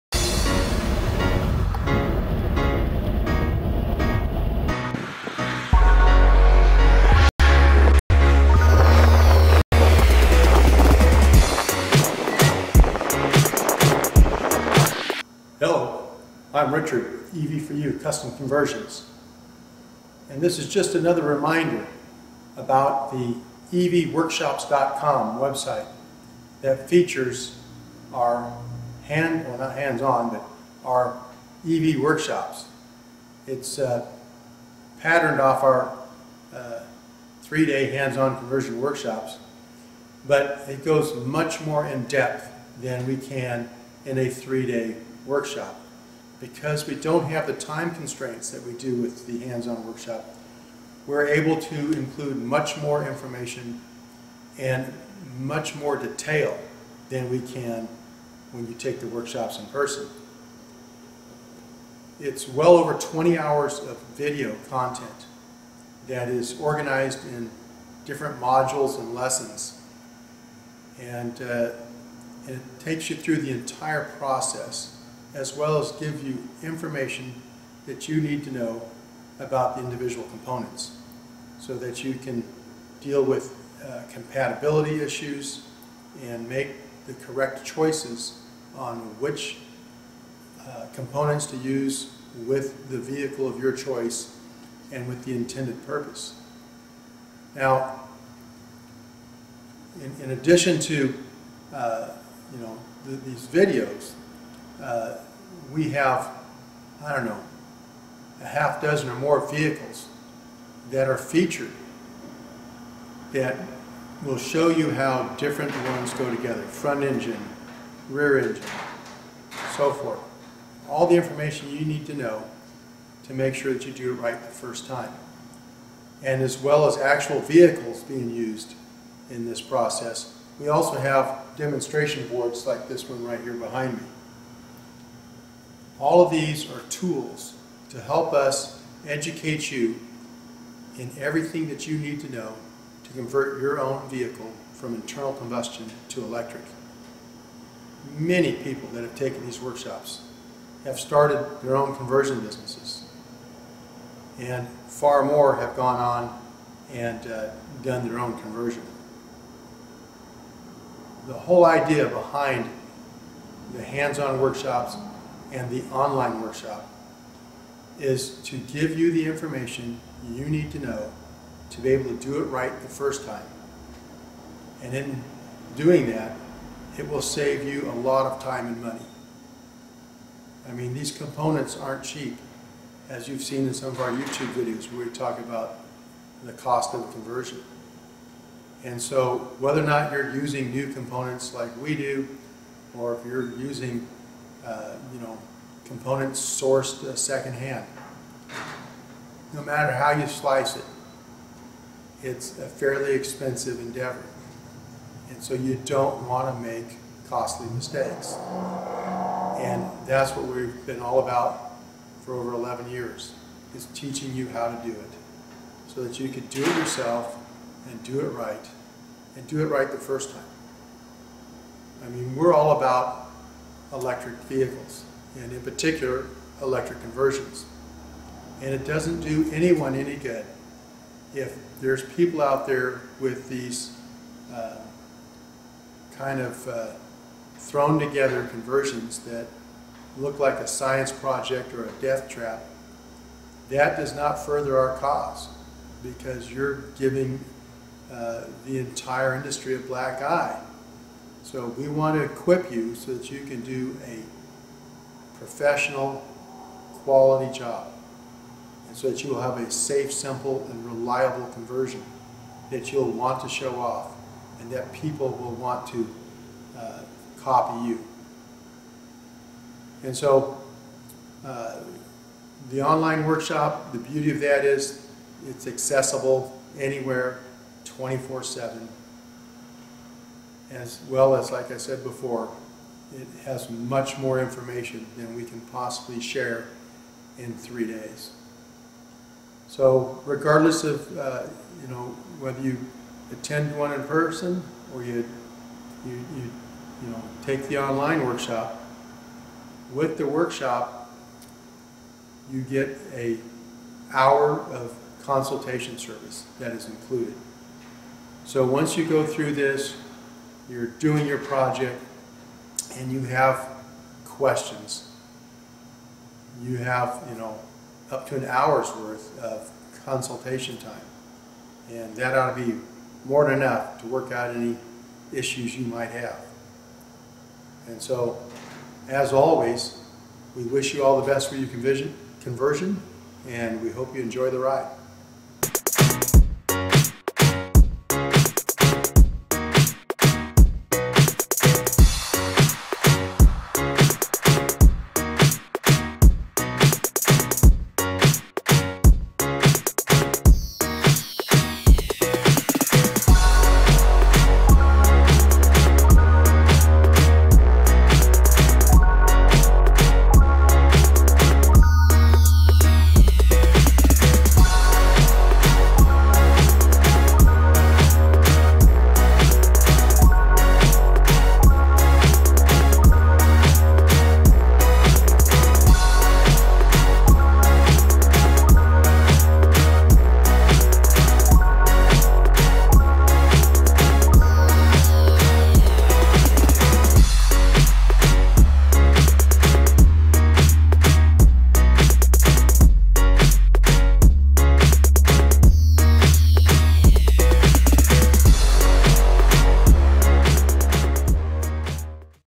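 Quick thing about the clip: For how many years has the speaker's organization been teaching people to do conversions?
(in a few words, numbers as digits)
over 11 years.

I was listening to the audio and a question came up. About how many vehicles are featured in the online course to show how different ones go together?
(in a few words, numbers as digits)
half dozen or more.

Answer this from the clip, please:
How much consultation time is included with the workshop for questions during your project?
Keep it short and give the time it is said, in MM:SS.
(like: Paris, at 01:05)
1 hour, at 05:03.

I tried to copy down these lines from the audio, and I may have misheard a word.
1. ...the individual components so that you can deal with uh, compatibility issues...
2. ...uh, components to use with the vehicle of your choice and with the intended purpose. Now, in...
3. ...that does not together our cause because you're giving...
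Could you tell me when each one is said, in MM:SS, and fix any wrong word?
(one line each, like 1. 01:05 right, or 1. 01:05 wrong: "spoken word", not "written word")
1. 01:19 right
2. 01:30 right
3. 04:03 wrong: "further", not "together".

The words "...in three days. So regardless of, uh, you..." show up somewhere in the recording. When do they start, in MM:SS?
04:47.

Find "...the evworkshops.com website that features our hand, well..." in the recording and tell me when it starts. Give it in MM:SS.
00:23.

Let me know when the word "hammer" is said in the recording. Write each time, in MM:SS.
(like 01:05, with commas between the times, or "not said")
not said.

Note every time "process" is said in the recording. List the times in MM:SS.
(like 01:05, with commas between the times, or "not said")
01:14, 02:09.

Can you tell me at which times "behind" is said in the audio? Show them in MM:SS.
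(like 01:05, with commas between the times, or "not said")
02:13, 02:42.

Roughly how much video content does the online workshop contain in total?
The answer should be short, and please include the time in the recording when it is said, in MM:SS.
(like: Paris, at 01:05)
over 20 hours, at 01:02.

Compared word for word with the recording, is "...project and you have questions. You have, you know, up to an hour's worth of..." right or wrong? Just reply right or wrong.
right.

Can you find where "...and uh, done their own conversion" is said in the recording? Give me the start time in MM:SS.
02:36.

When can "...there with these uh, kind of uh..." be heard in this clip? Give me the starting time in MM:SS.
03:52.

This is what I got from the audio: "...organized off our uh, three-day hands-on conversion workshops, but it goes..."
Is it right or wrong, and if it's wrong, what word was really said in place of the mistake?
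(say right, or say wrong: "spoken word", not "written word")
wrong: "patterned", not "organized".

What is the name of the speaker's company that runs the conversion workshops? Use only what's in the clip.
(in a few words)
EV for You Custom Conversions.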